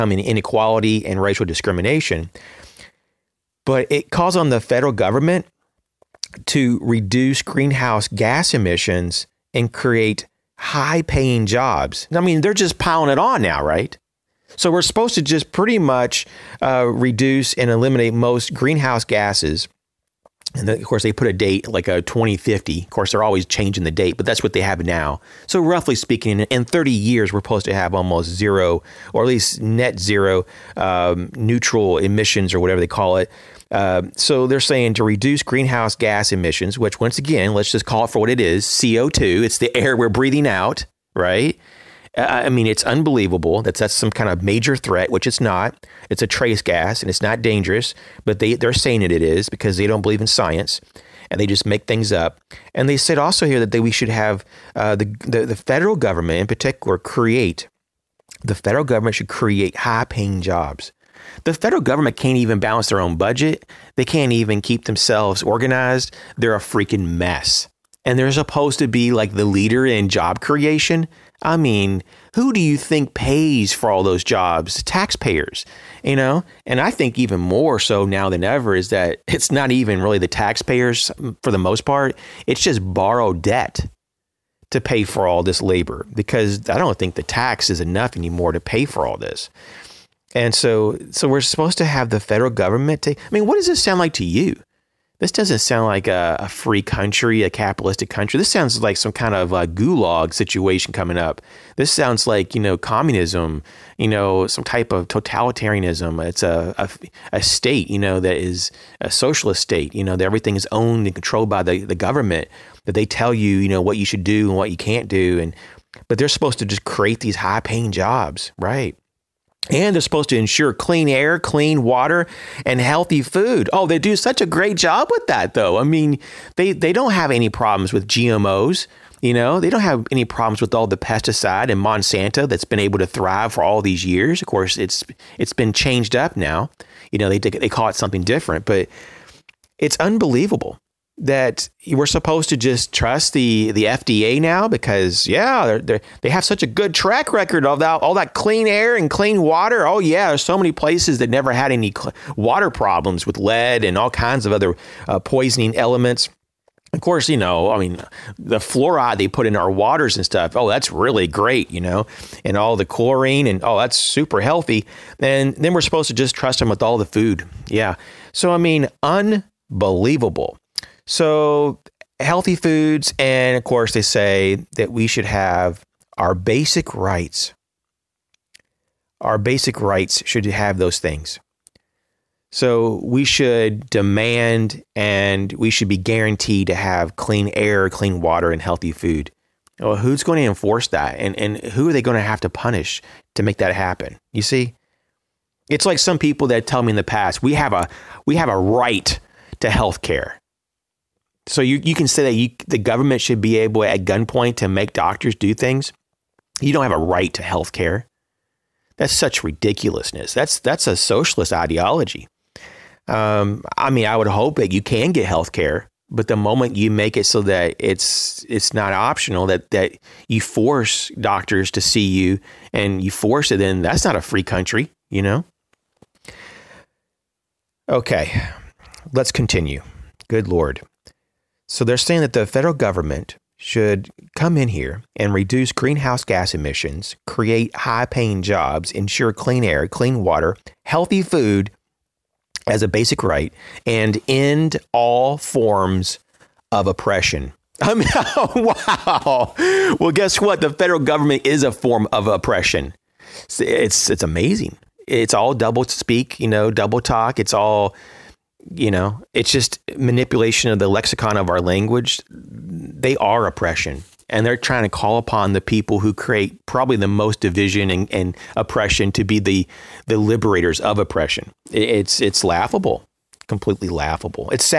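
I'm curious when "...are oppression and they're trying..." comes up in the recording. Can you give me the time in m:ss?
4:23.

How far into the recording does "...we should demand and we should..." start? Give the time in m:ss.
3:03.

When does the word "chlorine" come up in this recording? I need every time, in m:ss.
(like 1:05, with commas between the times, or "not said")
2:42.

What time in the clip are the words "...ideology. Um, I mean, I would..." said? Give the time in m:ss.
3:31.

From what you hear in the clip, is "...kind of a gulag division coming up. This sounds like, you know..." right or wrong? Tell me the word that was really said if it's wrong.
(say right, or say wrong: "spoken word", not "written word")
wrong: "situation", not "division".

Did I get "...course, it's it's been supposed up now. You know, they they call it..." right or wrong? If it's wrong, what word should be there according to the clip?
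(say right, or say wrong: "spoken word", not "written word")
wrong: "changed", not "supposed".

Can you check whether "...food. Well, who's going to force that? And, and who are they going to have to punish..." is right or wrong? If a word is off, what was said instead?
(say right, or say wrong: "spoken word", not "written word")
wrong: "enforce", not "force".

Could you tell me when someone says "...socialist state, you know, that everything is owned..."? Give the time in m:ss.
1:49.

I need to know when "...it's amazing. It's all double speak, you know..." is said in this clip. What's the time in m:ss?
4:14.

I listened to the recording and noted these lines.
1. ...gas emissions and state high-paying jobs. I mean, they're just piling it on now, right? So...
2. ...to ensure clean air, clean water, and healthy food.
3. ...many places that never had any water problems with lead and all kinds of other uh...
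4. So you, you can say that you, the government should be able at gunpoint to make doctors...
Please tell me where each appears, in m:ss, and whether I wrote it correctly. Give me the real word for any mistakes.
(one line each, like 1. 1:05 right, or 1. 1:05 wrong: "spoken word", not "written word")
1. 0:08 wrong: "create", not "state"
2. 2:00 right
3. 2:30 right
4. 3:21 right.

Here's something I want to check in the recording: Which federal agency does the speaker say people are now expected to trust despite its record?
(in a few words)
FDA.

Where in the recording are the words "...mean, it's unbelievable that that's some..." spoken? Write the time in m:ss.
0:42.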